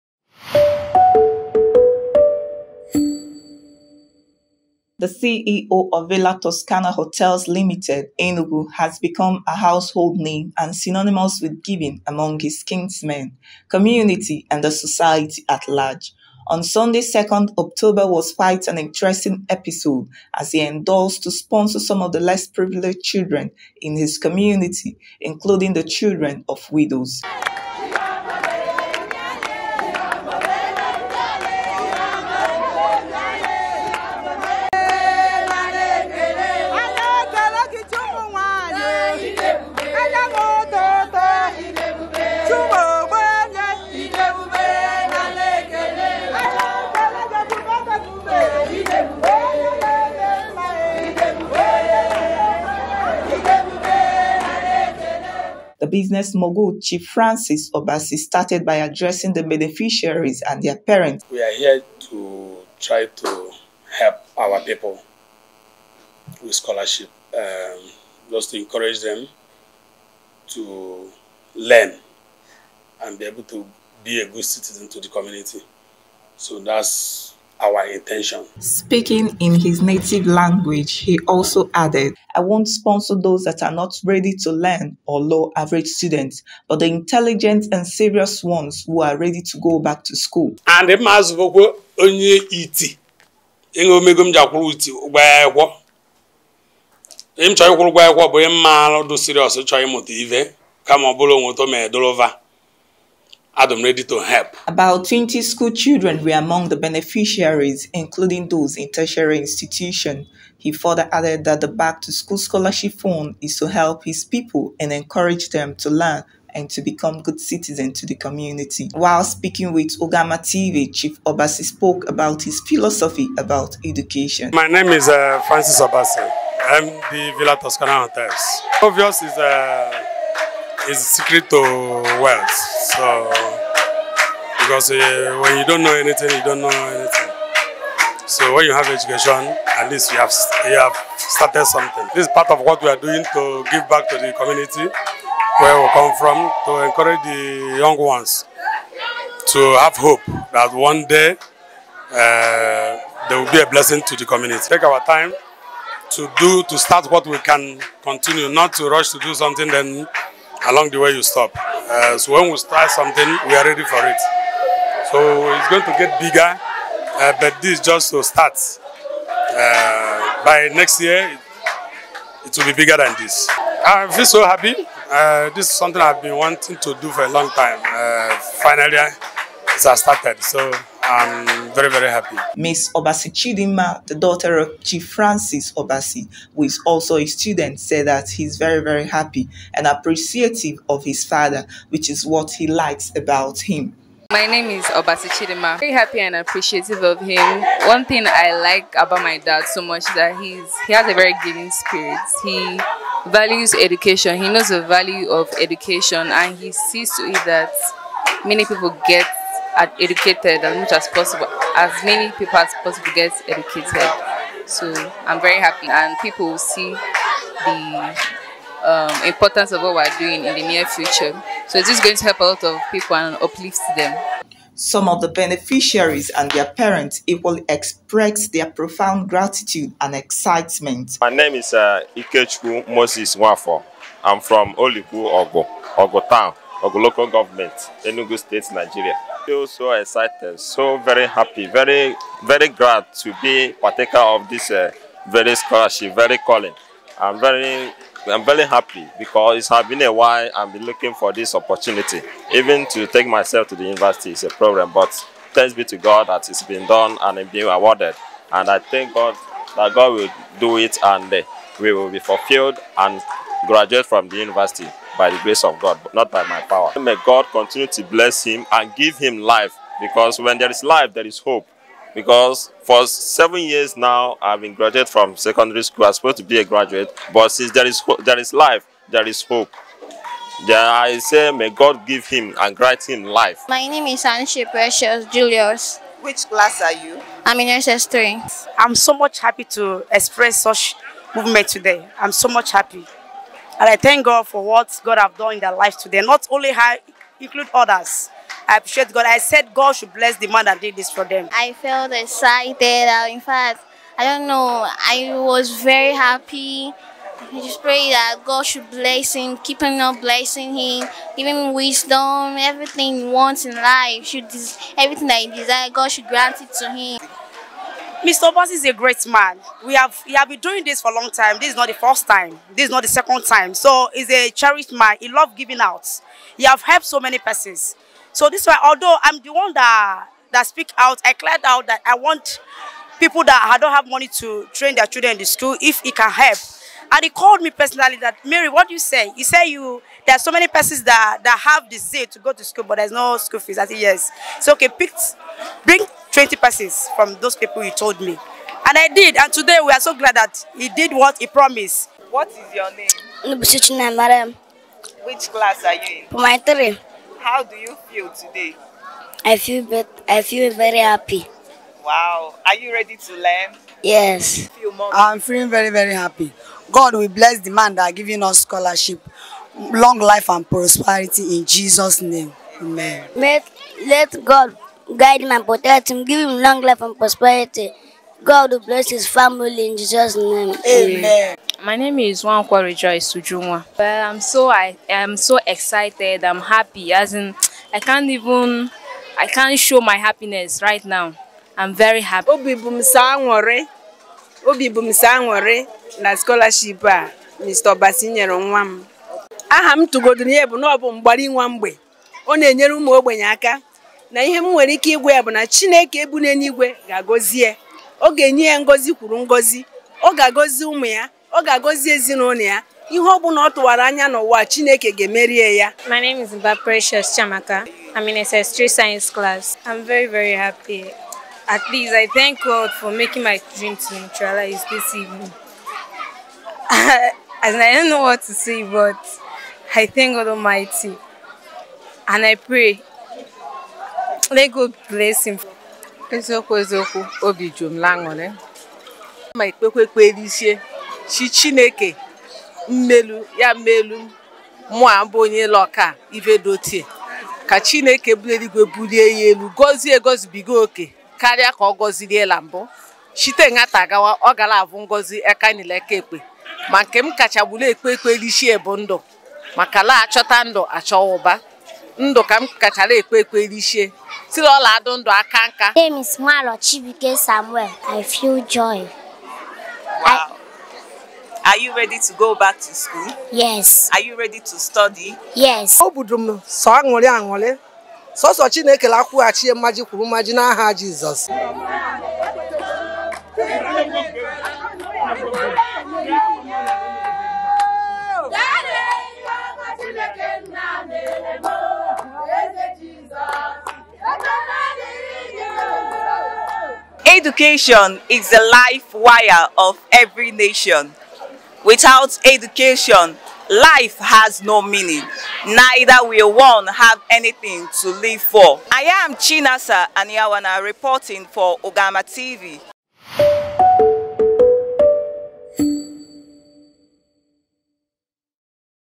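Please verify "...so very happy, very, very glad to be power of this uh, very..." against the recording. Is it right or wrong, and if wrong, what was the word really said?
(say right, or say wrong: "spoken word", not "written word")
wrong: "partaker", not "power".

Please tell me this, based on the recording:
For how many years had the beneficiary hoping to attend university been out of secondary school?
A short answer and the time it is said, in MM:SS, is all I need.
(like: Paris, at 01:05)
7, at 04:33.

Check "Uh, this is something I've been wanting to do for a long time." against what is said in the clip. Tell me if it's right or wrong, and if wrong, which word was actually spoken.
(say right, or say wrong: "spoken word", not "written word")
right.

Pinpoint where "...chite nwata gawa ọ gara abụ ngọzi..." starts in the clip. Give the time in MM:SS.
07:33.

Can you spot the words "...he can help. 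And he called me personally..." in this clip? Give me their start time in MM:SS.
05:36.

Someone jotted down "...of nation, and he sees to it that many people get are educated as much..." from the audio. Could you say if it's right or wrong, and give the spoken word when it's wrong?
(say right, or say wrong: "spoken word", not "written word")
wrong: "education", not "nation".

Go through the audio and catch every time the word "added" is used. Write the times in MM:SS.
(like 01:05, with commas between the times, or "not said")
01:21, 01:51.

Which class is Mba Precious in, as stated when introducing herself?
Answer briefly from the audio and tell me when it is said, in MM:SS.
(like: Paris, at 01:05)
SS3 science class, at 06:58.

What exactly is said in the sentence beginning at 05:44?
So, okay, pick, bring 20 persons from those people you told me.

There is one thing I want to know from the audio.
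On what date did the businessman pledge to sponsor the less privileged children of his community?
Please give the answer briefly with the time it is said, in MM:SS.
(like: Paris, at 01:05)
Sunday, 2nd October, at 00:16.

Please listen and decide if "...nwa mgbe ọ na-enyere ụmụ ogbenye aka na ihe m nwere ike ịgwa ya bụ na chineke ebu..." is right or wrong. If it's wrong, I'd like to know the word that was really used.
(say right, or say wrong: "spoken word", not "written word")
right.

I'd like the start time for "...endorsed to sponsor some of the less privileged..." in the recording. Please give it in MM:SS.
00:20.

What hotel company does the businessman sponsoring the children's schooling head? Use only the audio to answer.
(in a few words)
Villa Toskana Hotels Limited.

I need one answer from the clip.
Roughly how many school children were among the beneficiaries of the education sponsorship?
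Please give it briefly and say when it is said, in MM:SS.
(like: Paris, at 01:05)
20, at 01:44.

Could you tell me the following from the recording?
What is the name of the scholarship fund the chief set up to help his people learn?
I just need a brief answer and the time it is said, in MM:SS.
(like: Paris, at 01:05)
Back to School Scholarship Fund, at 01:51.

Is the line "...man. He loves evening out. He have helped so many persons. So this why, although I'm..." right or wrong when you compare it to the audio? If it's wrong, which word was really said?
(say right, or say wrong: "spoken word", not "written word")
wrong: "giving", not "evening".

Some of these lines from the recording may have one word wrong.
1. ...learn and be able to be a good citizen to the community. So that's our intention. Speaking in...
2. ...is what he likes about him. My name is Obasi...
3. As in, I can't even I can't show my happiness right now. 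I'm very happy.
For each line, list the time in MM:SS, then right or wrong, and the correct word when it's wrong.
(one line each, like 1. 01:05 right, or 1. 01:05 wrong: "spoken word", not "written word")
1. 01:11 right
2. 03:12 right
3. 06:27 right.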